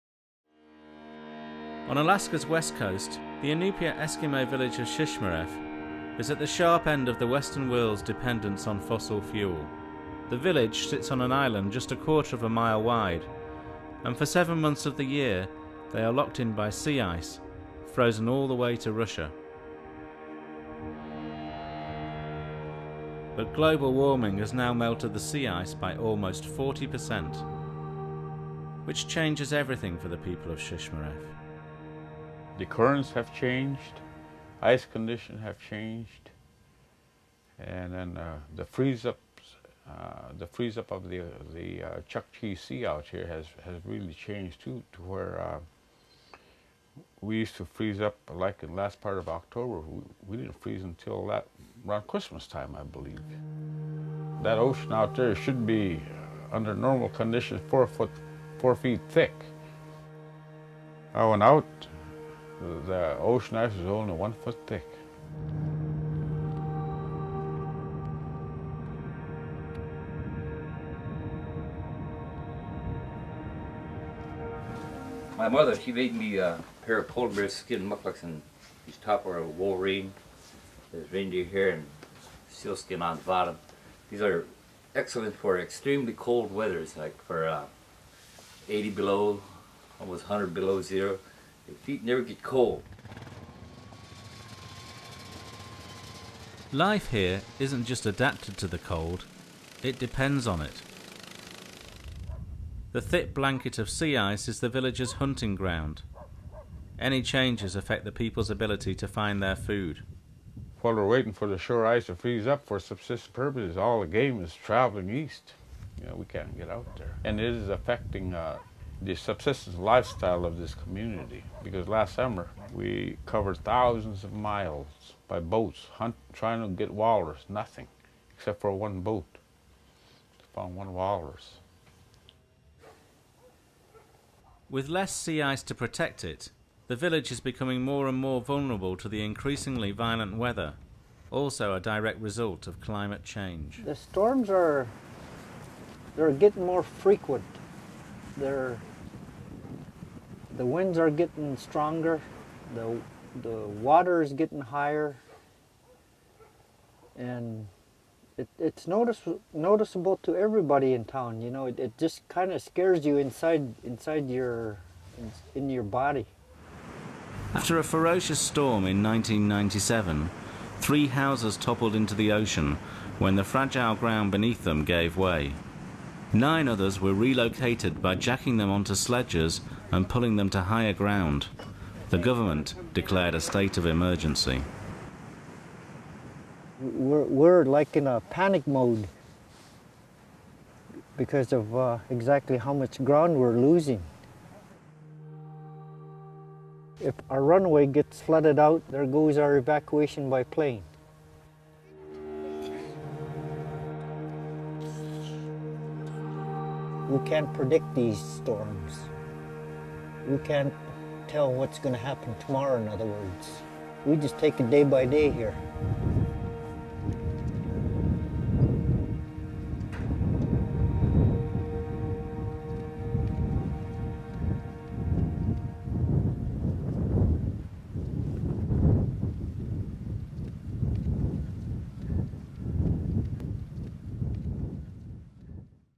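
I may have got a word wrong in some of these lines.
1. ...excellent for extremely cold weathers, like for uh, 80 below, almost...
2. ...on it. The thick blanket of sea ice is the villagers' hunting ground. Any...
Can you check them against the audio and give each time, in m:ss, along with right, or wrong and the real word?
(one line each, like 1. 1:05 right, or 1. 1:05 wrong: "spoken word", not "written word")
1. 1:24 right
2. 1:40 right.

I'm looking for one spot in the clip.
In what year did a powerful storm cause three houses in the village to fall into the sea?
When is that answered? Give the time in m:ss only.
2:49.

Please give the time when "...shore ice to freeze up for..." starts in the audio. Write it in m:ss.
1:51.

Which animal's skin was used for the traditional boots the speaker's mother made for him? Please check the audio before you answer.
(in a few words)
Polar bear.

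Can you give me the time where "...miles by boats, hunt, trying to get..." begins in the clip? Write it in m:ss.
2:04.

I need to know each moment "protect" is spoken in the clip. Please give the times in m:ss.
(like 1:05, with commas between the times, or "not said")
2:15.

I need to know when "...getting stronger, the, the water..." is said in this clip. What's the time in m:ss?
2:31.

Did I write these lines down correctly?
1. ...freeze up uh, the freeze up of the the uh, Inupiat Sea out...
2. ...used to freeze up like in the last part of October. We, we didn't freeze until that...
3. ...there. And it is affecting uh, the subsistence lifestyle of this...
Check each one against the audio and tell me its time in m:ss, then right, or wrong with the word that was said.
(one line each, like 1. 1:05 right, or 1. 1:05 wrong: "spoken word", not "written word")
1. 0:38 wrong: "Chukchi", not "Inupiat"
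2. 0:47 right
3. 1:56 right.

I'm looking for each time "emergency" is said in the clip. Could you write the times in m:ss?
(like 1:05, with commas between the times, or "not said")
3:03.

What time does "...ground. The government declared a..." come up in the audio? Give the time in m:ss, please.
3:00.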